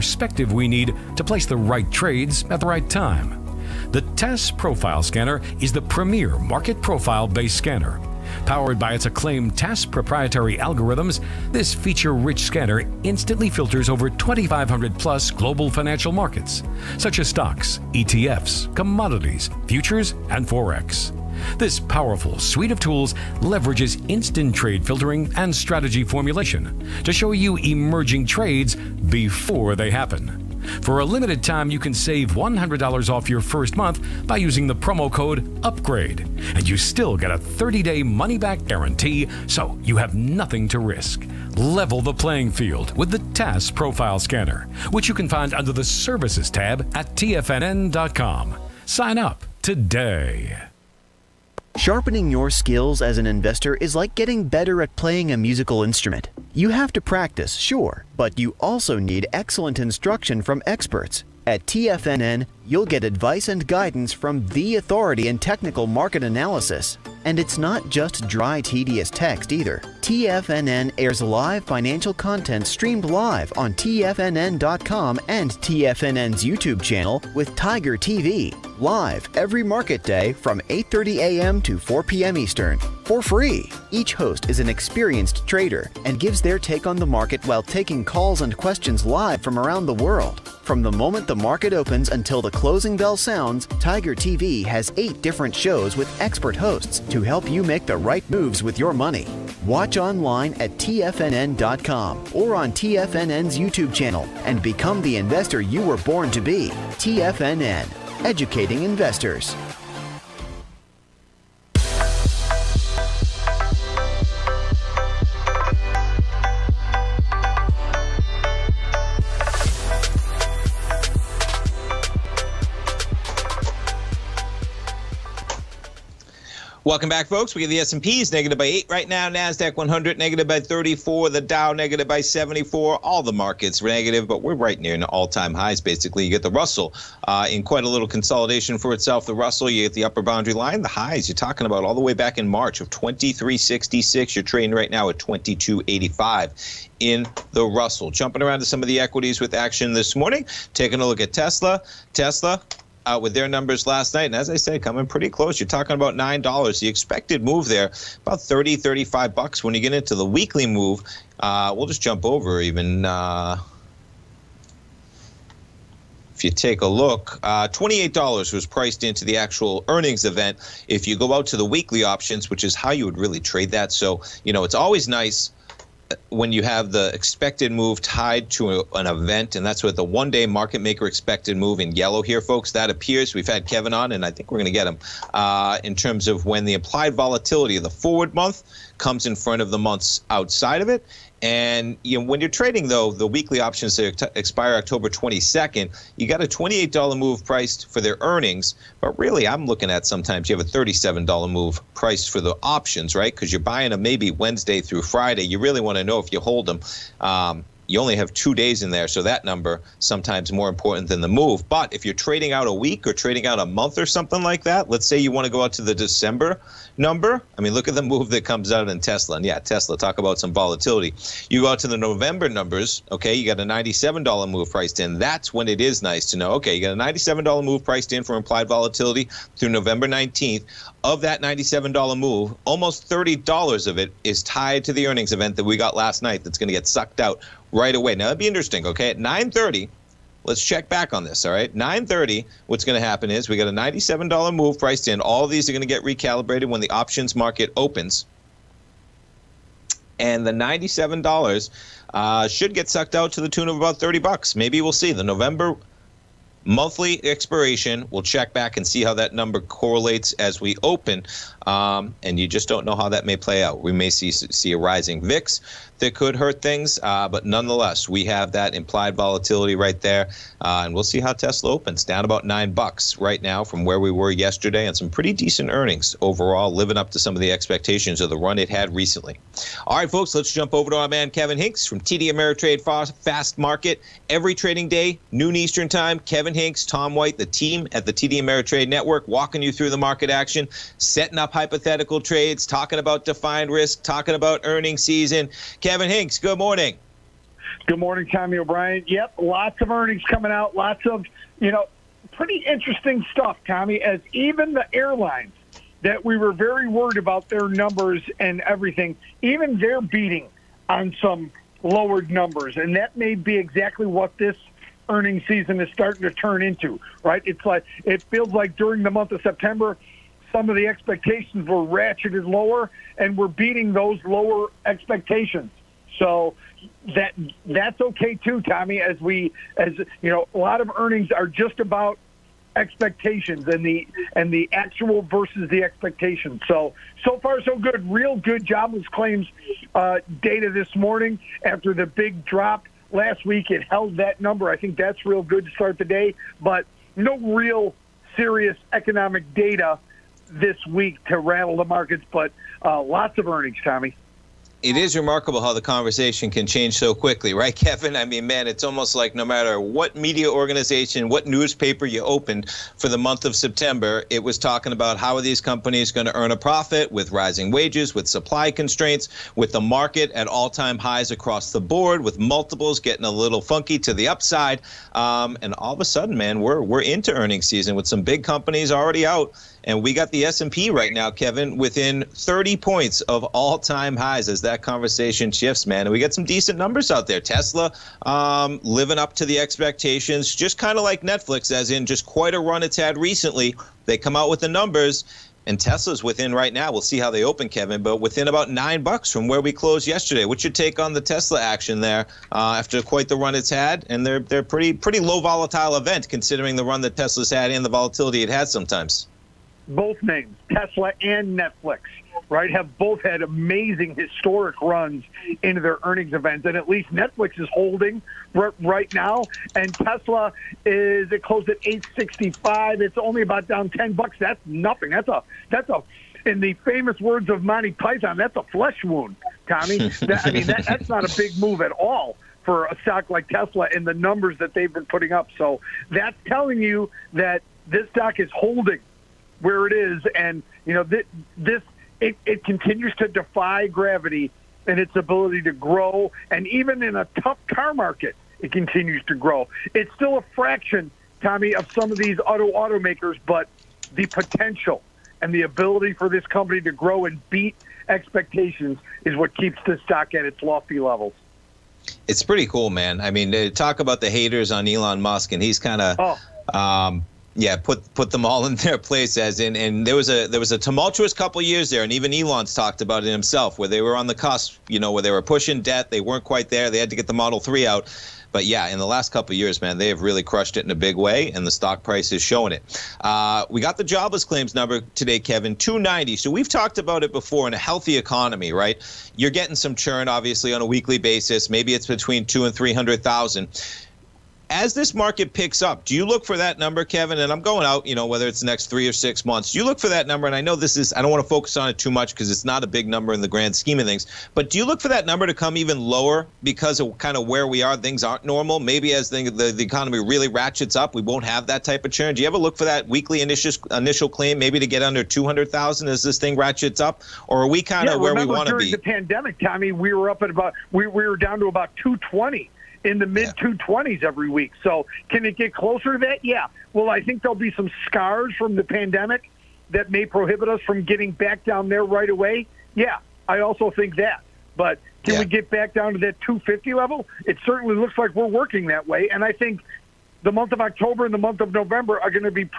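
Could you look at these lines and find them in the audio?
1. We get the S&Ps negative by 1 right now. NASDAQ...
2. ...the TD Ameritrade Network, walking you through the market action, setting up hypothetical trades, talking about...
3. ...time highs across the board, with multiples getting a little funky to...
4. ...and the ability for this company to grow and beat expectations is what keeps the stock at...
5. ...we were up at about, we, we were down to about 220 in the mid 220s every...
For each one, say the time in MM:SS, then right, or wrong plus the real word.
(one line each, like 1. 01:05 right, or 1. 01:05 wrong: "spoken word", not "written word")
1. 02:07 wrong: "8", not "1"
2. 04:48 right
3. 06:10 right
4. 07:35 right
5. 08:39 right.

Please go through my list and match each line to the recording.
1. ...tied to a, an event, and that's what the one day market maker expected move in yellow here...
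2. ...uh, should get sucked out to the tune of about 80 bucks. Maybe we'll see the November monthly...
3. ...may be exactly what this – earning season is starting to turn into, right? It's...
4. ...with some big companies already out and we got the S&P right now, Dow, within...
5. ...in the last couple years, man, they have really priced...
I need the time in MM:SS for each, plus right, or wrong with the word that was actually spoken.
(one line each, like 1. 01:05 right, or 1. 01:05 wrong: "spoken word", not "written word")
1. 02:58 right
2. 04:12 wrong: "30", not "80"
3. 05:13 right
4. 06:17 wrong: "Kevin", not "Dow"
5. 07:58 wrong: "crushed", not "priced".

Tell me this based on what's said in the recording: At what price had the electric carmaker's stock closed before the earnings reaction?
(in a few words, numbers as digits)
865.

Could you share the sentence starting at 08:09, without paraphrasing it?
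You're getting some churn, obviously, on a weekly basis.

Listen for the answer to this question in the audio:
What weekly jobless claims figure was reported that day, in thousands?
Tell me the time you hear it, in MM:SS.
08:05.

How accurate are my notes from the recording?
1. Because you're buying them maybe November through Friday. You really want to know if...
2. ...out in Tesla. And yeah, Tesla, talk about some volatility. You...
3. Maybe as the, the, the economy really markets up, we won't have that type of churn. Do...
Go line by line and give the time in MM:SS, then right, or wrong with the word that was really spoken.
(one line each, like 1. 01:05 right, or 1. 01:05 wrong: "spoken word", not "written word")
1. 03:23 wrong: "Wednesday", not "November"
2. 03:38 right
3. 08:28 wrong: "ratchets", not "markets".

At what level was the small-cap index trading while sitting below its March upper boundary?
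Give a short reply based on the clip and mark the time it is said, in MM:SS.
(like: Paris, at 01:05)
2285, at 02:25.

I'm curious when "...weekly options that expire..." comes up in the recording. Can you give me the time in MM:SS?
03:13.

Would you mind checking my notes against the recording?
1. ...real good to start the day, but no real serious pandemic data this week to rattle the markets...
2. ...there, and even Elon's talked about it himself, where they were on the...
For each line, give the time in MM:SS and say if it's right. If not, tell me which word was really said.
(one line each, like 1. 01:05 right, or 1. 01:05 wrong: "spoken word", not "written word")
1. 05:45 wrong: "economic", not "pandemic"
2. 07:51 right.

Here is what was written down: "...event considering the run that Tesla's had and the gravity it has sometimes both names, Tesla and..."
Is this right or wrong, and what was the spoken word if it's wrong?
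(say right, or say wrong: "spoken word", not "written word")
wrong: "volatility", not "gravity".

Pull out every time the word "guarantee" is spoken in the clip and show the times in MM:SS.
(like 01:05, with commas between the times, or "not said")
00:38.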